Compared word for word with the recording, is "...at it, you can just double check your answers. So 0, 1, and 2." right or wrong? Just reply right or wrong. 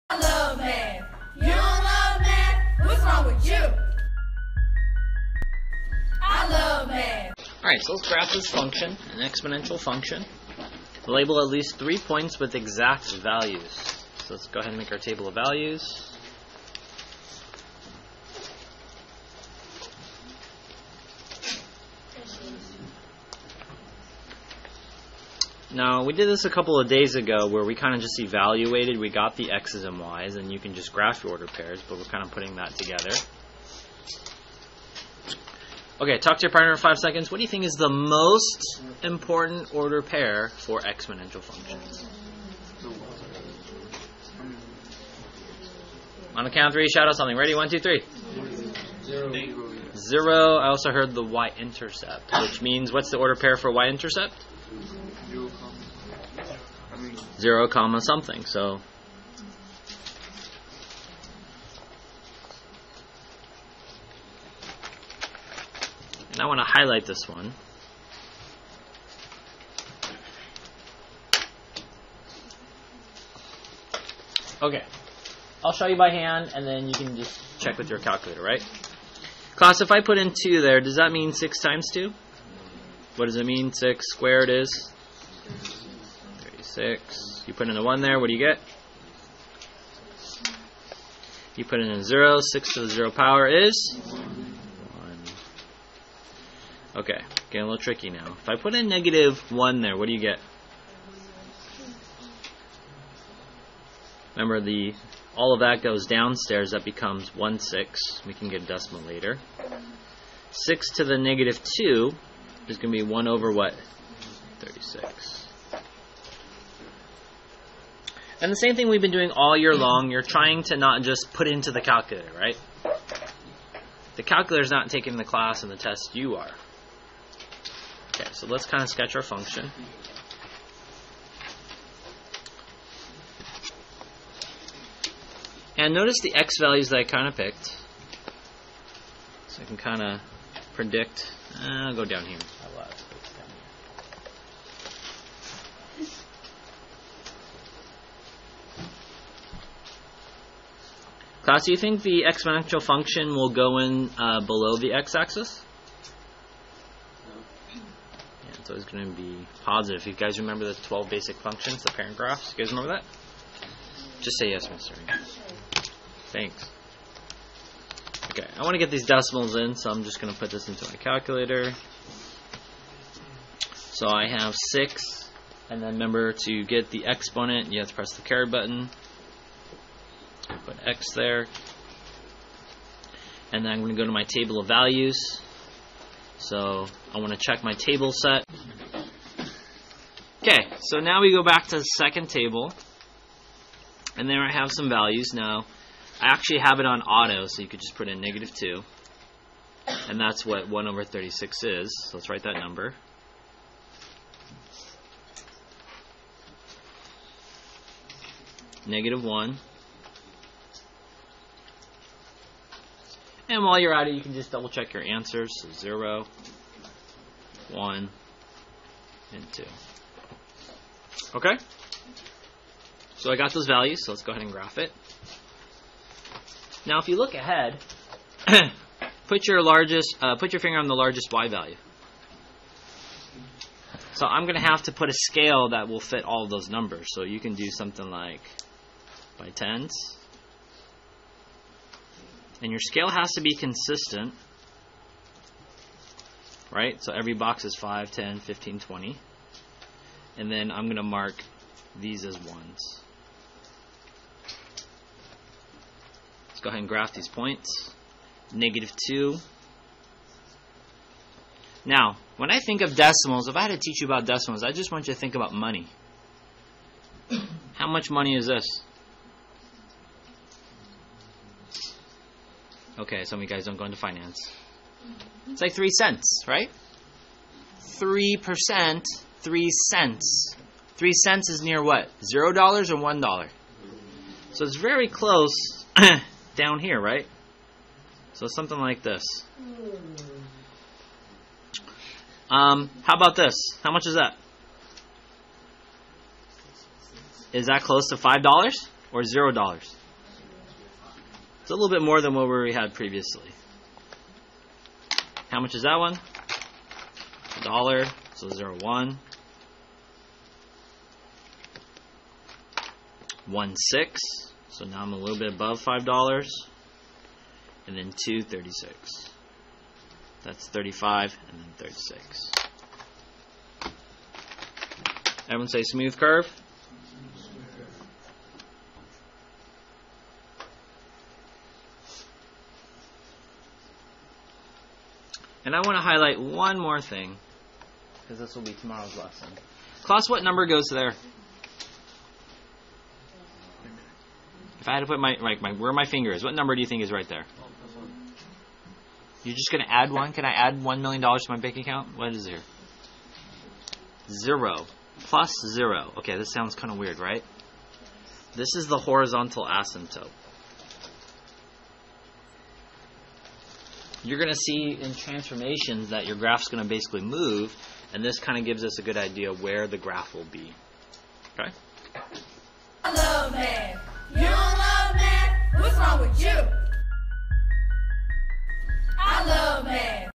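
right.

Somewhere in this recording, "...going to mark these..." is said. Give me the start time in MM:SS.
04:10.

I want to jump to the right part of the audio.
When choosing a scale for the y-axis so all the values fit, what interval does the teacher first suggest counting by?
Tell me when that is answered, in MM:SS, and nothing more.
03:59.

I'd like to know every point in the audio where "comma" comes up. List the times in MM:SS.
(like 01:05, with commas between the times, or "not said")
00:57.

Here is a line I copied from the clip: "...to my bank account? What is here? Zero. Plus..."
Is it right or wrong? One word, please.
right.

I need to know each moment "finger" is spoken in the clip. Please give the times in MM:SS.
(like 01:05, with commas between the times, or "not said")
03:50, 05:46.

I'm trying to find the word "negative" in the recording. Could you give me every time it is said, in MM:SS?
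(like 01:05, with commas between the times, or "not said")
01:38, 01:51, 03:18, 03:28, 04:18.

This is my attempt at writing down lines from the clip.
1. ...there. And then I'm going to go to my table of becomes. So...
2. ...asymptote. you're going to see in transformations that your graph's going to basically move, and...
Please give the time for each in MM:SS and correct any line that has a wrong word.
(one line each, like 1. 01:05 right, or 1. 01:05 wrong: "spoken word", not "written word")
1. 03:01 wrong: "values", not "becomes"
2. 05:59 right.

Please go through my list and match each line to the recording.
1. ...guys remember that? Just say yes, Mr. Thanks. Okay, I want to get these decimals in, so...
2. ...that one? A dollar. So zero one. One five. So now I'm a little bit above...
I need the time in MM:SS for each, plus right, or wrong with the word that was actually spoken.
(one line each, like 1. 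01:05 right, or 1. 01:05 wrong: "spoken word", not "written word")
1. 02:42 right
2. 05:05 wrong: "six", not "five".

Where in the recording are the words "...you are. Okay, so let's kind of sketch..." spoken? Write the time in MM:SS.
02:06.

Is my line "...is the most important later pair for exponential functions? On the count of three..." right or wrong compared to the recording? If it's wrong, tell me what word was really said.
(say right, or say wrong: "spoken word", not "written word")
wrong: "order", not "later".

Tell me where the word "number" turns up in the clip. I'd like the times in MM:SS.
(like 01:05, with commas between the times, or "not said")
03:22, 03:56, 05:40, 05:46.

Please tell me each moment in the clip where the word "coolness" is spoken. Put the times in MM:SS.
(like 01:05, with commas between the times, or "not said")
not said.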